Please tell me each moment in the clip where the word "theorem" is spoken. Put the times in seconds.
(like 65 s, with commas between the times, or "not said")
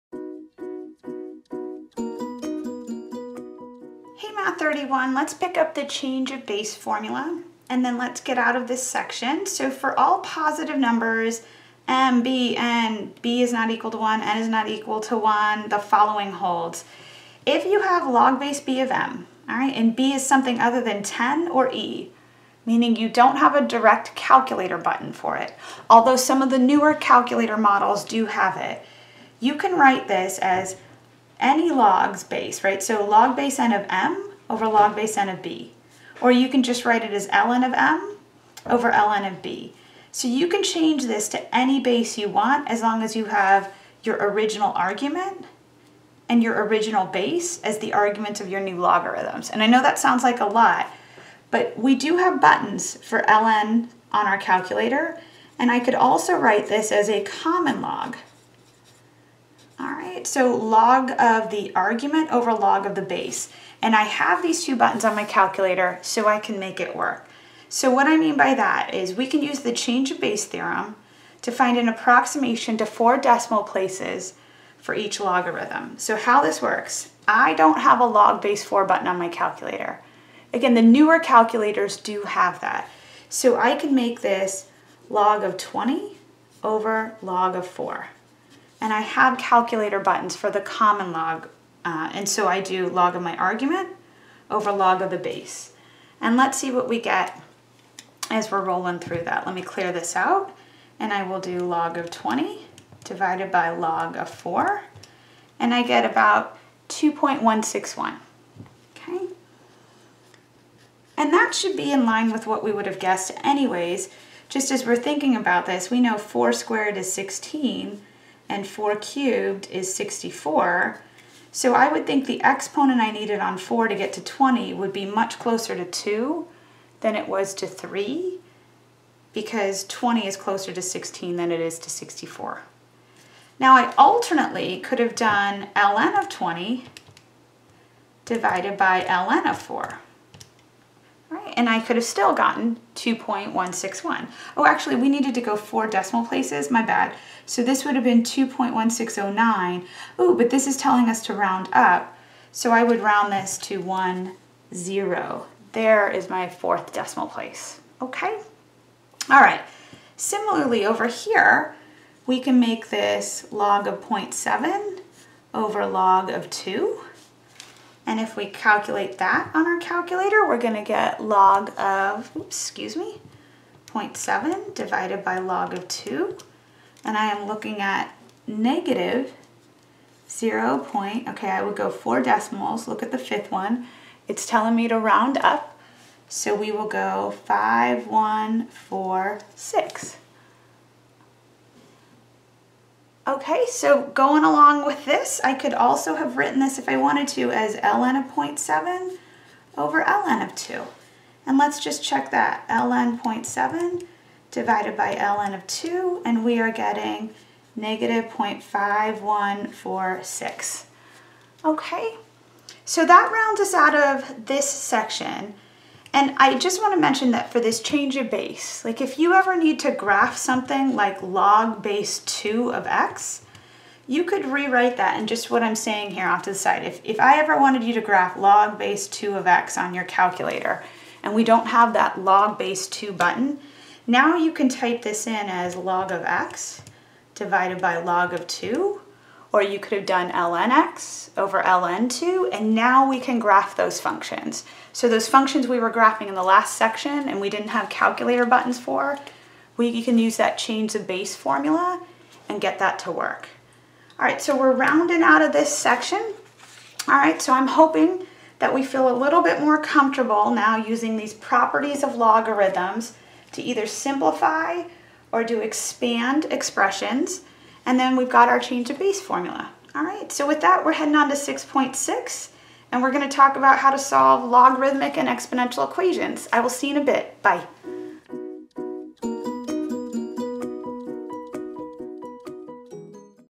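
70 s.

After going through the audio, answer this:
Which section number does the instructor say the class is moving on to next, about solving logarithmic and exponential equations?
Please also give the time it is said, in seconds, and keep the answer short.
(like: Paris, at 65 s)
6.6, at 271 s.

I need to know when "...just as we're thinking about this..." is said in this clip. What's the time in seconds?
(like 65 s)
114 s.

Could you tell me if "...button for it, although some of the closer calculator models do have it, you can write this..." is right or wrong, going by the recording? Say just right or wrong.
wrong.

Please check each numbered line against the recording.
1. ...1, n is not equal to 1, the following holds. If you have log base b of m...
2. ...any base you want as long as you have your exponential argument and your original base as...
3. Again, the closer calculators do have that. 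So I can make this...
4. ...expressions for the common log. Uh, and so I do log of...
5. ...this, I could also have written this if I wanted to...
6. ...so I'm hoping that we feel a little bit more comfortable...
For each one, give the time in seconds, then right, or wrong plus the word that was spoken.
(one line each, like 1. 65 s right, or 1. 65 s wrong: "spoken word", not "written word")
1. 13 s right
2. 41 s wrong: "original", not "exponential"
3. 80 s wrong: "newer", not "closer"
4. 90 s wrong: "buttons", not "expressions"
5. 195 s right
6. 257 s right.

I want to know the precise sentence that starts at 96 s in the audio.
And let's see what we get as we're rolling through that.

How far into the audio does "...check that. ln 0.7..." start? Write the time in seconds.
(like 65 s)
202 s.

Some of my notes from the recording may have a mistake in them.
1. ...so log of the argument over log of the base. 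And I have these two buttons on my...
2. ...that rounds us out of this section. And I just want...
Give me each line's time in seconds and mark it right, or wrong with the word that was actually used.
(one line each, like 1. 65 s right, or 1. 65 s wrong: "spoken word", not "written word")
1. 60 s right
2. 213 s right.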